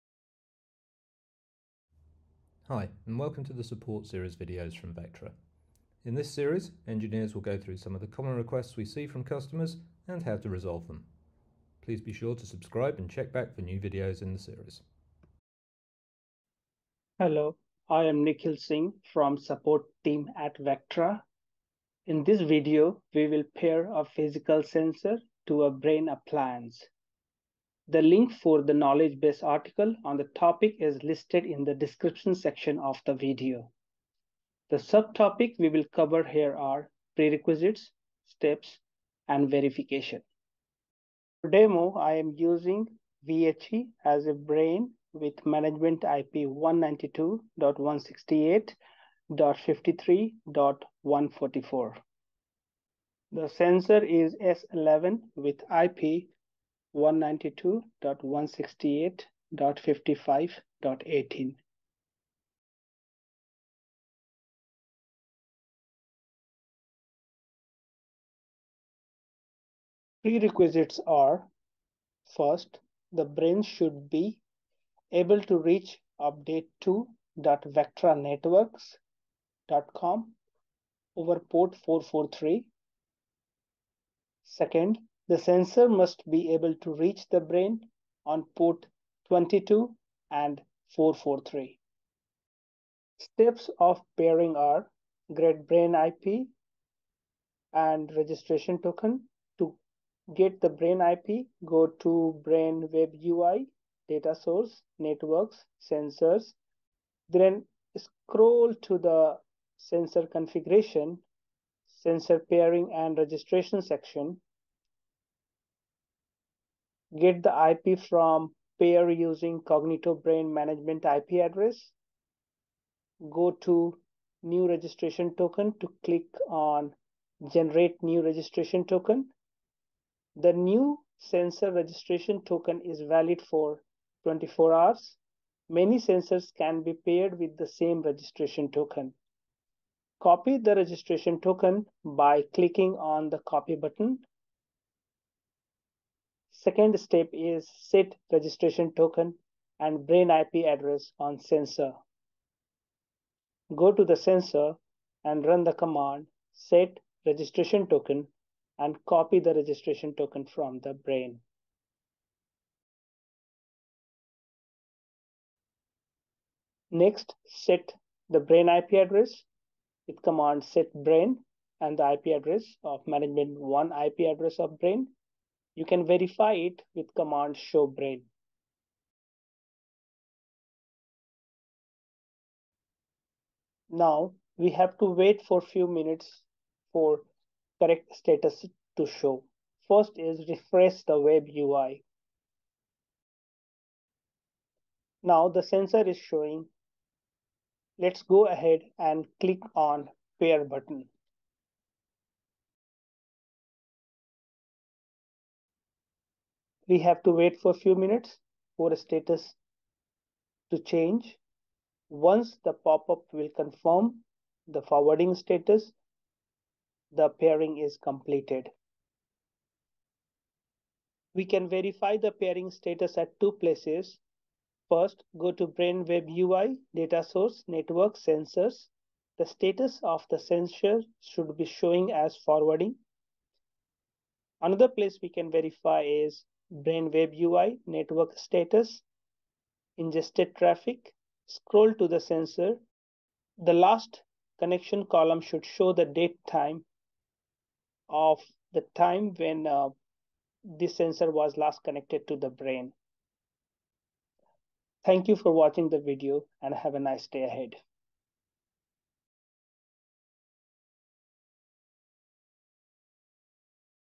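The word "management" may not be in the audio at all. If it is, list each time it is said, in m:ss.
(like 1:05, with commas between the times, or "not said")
0:45, 2:00, 2:53.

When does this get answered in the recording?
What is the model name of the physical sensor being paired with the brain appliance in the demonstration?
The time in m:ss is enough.
0:54.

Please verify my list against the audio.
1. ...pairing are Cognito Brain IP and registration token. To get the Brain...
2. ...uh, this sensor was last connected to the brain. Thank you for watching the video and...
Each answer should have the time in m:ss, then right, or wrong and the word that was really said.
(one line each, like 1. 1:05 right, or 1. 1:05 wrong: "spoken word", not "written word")
1. 1:34 wrong: "Great", not "Cognito"
2. 4:09 right.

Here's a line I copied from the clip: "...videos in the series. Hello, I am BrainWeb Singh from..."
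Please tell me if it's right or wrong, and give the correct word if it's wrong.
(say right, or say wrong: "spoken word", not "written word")
wrong: "Nikhil", not "BrainWeb".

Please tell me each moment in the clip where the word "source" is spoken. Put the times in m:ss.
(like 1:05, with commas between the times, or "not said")
1:44, 3:47.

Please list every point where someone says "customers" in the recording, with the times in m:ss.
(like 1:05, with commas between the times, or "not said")
0:09.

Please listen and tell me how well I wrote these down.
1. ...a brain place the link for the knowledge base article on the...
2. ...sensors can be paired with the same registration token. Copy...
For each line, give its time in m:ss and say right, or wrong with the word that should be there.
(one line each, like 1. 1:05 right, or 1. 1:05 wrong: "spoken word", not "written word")
1. 0:25 wrong: "appliance", not "place"
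2. 2:15 right.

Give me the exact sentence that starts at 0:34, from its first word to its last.
The subtopic we will cover here are prerequisites, steps, and verification.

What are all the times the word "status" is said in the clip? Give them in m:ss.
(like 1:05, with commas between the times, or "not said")
3:08, 3:28, 3:35, 3:42, 3:49, 3:58.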